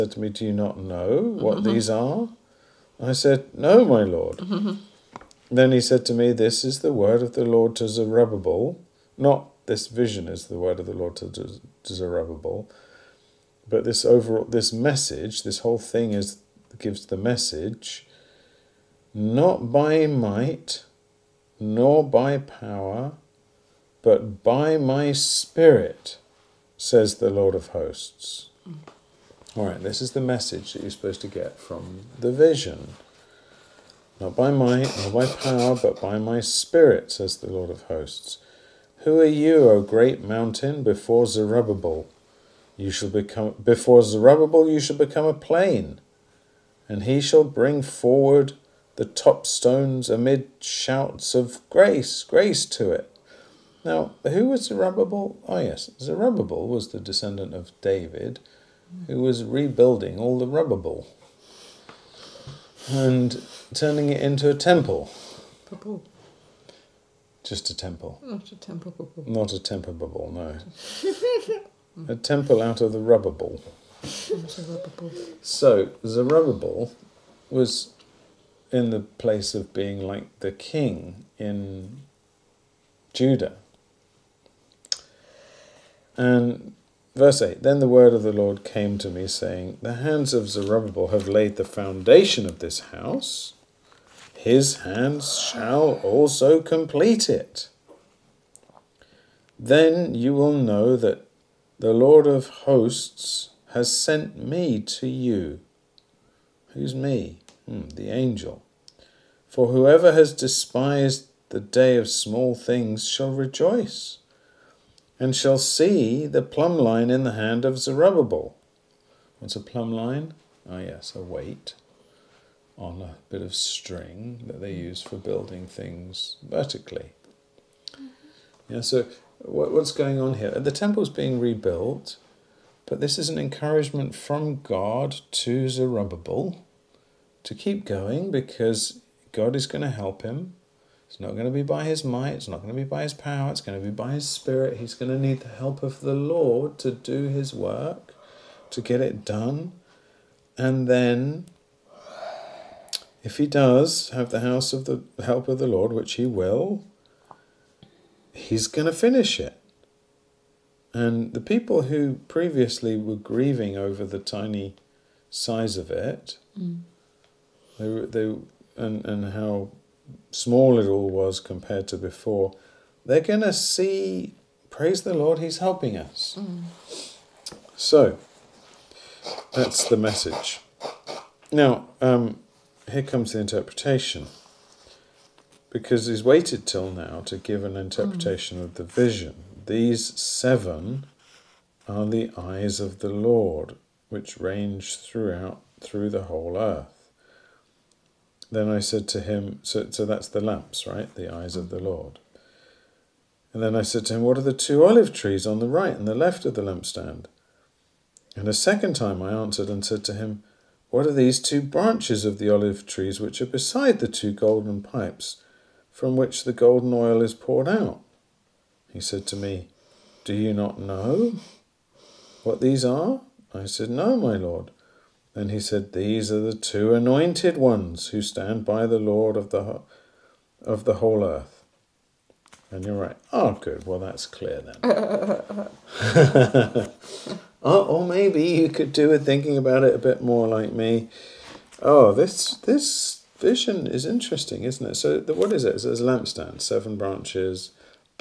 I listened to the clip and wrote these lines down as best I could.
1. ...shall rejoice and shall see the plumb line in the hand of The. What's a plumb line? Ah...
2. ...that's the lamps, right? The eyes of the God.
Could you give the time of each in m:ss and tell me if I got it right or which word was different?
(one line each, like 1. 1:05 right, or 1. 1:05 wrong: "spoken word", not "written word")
1. 1:53 wrong: "Zerubbabel", not "The"
2. 3:20 wrong: "Lord", not "God".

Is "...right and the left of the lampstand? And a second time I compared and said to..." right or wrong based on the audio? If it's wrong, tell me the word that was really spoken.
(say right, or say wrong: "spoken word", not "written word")
wrong: "answered", not "compared".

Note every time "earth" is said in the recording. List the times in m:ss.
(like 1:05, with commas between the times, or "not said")
3:16, 3:51.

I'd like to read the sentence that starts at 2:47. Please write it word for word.
they, they, and, and how small it all was compared to before, they're going to see, praise the Lord, He's helping us.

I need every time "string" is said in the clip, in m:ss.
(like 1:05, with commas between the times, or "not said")
2:03.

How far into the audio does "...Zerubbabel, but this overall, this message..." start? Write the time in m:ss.
0:11.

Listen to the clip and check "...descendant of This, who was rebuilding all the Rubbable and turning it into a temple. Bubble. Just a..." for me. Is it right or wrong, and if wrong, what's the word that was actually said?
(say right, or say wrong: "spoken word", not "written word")
wrong: "David", not "This".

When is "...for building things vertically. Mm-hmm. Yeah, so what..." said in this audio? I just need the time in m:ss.
2:05.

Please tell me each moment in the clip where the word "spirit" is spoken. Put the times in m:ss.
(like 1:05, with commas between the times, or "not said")
0:25, 0:36, 2:24.